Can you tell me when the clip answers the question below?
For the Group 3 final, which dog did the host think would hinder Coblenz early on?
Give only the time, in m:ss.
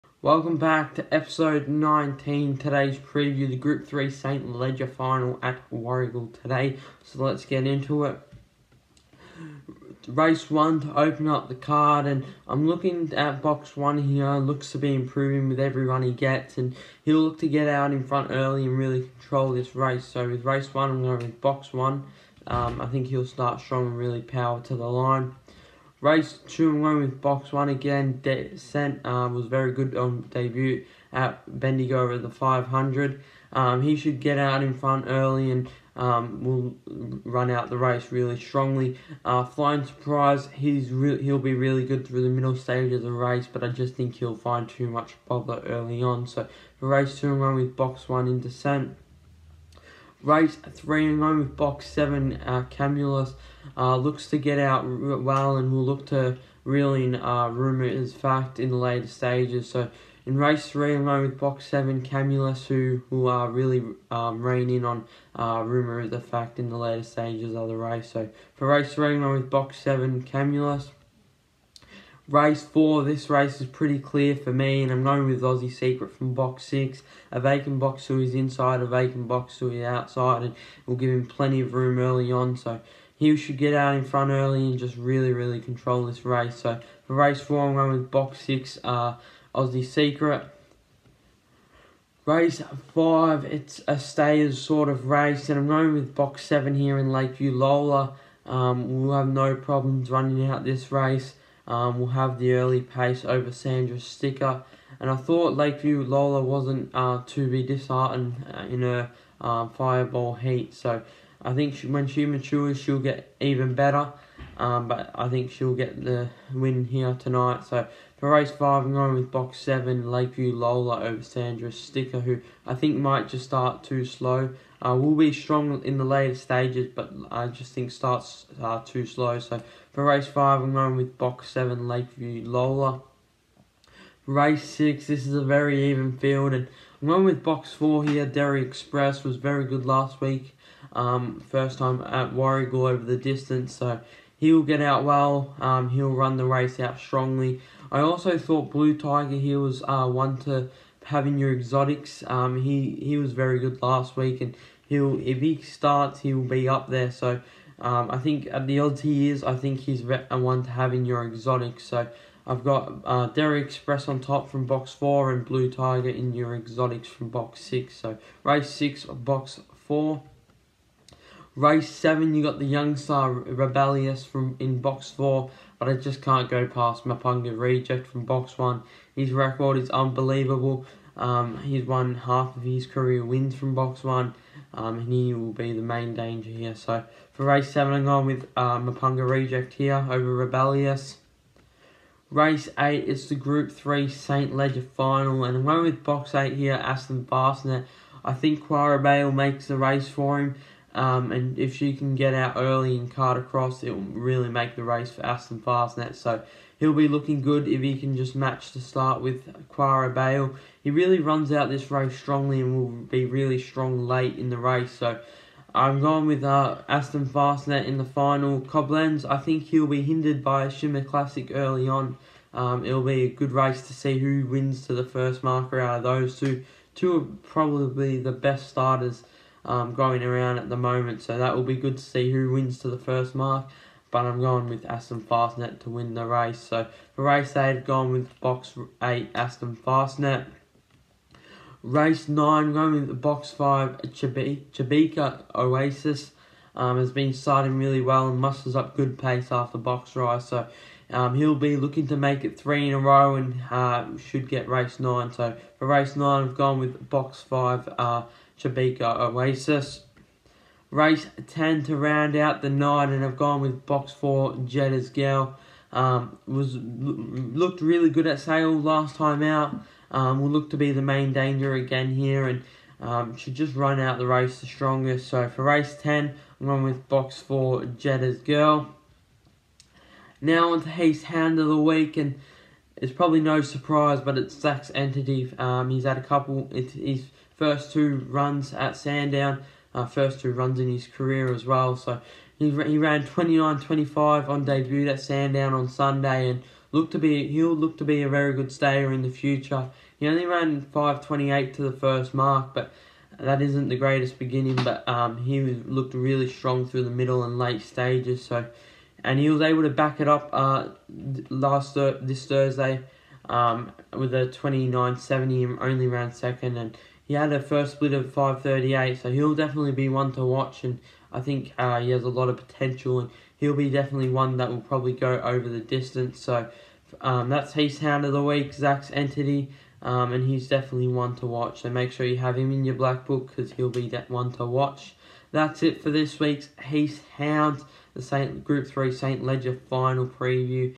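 3:40.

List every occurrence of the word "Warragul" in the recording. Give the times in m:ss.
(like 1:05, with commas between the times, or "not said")
0:05, 2:22.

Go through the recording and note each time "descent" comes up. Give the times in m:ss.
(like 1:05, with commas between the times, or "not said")
0:28, 0:48.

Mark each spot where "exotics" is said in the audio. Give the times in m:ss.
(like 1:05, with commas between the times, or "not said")
2:31, 2:41, 2:46.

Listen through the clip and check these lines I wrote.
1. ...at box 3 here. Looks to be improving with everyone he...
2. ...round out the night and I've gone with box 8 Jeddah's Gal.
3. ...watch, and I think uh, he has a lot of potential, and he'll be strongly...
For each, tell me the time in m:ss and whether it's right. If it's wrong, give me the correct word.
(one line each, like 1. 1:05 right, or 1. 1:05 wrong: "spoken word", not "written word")
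1. 0:13 wrong: "1", not "3"
2. 4:21 wrong: "4", not "8"
3. 5:20 wrong: "definitely", not "strongly".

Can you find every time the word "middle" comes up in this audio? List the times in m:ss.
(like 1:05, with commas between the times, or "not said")
0:42, 5:07.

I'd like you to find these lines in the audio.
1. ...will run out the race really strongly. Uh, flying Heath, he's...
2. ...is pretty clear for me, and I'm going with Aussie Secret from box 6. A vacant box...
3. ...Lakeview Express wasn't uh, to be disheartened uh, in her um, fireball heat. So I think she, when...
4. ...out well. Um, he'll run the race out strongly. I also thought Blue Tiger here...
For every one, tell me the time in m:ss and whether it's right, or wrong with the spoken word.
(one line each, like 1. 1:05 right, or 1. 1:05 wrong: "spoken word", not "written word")
1. 0:36 wrong: "Surprise", not "Heath"
2. 1:13 right
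3. 1:45 wrong: "Lola", not "Express"
4. 2:24 right.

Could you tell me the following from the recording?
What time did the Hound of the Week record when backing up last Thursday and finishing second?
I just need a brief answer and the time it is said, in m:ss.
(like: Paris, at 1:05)
29.70, at 5:14.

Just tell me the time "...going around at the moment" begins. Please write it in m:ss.
3:49.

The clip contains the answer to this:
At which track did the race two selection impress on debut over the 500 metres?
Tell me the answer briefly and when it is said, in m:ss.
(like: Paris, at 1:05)
Bendigo, at 0:31.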